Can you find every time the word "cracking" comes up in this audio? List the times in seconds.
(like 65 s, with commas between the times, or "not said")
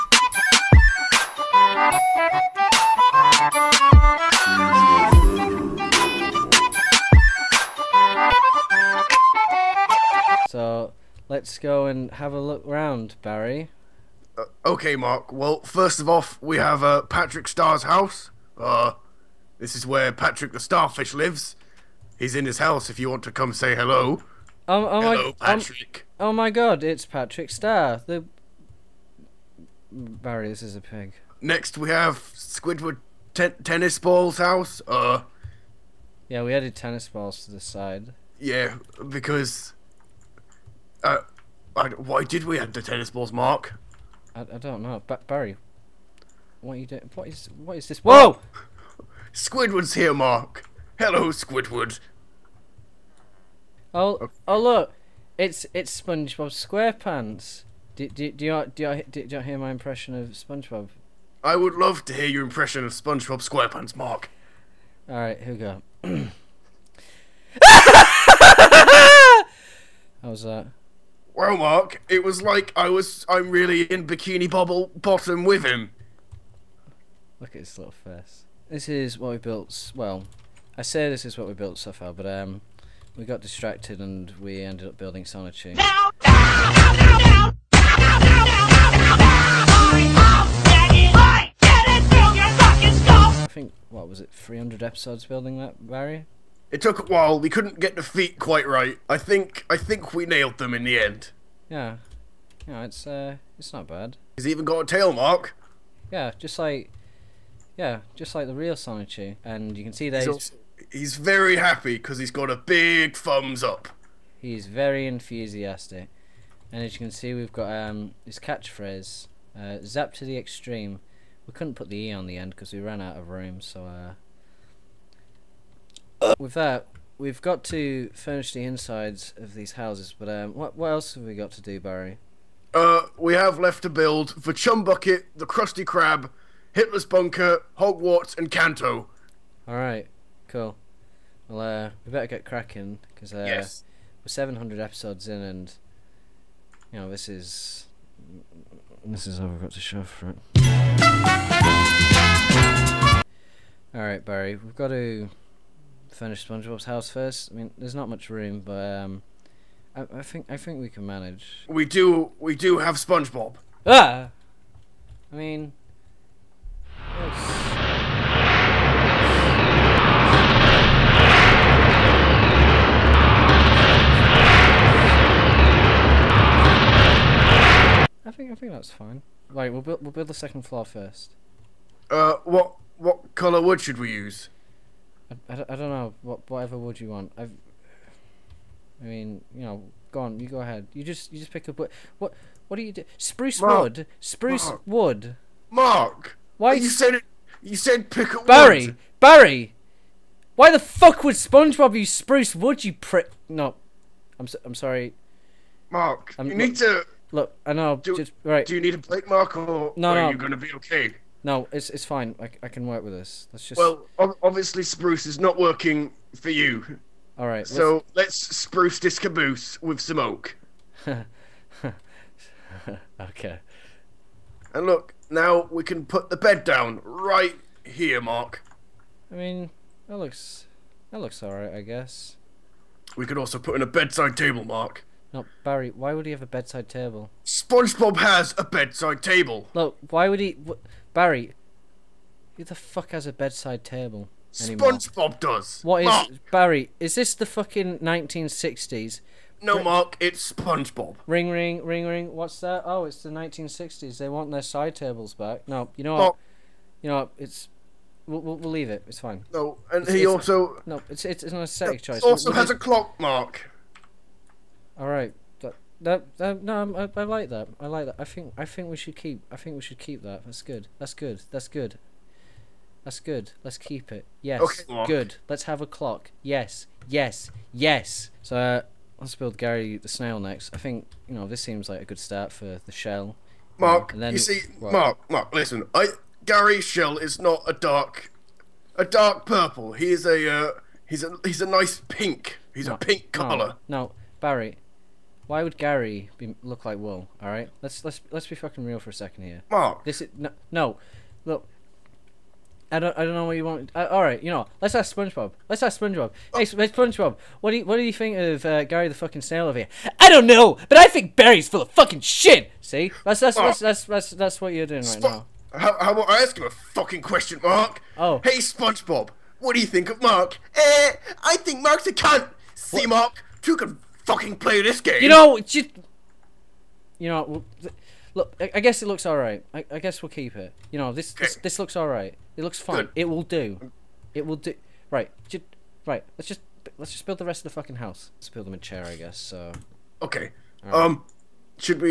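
142 s.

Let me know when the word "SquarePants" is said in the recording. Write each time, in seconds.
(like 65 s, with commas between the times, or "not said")
56 s, 63 s.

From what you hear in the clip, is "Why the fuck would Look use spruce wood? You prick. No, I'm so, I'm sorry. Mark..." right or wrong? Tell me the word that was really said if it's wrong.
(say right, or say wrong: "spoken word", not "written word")
wrong: "SpongeBob", not "Look".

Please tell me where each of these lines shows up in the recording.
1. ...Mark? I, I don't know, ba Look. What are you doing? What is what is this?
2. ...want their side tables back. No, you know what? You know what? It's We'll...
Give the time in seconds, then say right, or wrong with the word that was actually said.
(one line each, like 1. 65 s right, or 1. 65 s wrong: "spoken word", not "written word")
1. 43 s wrong: "Barry", not "Look"
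2. 254 s right.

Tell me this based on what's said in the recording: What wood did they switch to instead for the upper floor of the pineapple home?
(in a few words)
Oak.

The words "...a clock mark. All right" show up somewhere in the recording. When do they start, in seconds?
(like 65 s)
262 s.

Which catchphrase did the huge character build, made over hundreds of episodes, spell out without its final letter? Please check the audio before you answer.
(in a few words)
Zap to the extreme.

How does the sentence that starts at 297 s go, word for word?
All right, let's let's let's be fucking real for a second here.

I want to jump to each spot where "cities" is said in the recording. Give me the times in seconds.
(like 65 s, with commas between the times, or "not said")
not said.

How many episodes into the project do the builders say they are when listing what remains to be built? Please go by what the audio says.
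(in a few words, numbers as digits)
700.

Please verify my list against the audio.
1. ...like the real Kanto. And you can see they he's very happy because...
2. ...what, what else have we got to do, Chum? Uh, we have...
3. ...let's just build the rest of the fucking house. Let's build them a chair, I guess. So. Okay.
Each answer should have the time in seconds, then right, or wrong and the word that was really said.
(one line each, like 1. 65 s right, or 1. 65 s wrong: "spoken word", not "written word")
1. 108 s wrong: "Sonichu", not "Kanto"
2. 130 s wrong: "Barry", not "Chum"
3. 336 s right.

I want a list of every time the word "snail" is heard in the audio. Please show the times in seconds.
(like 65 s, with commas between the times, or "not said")
280 s, 309 s.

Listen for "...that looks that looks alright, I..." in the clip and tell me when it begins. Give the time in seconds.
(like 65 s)
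230 s.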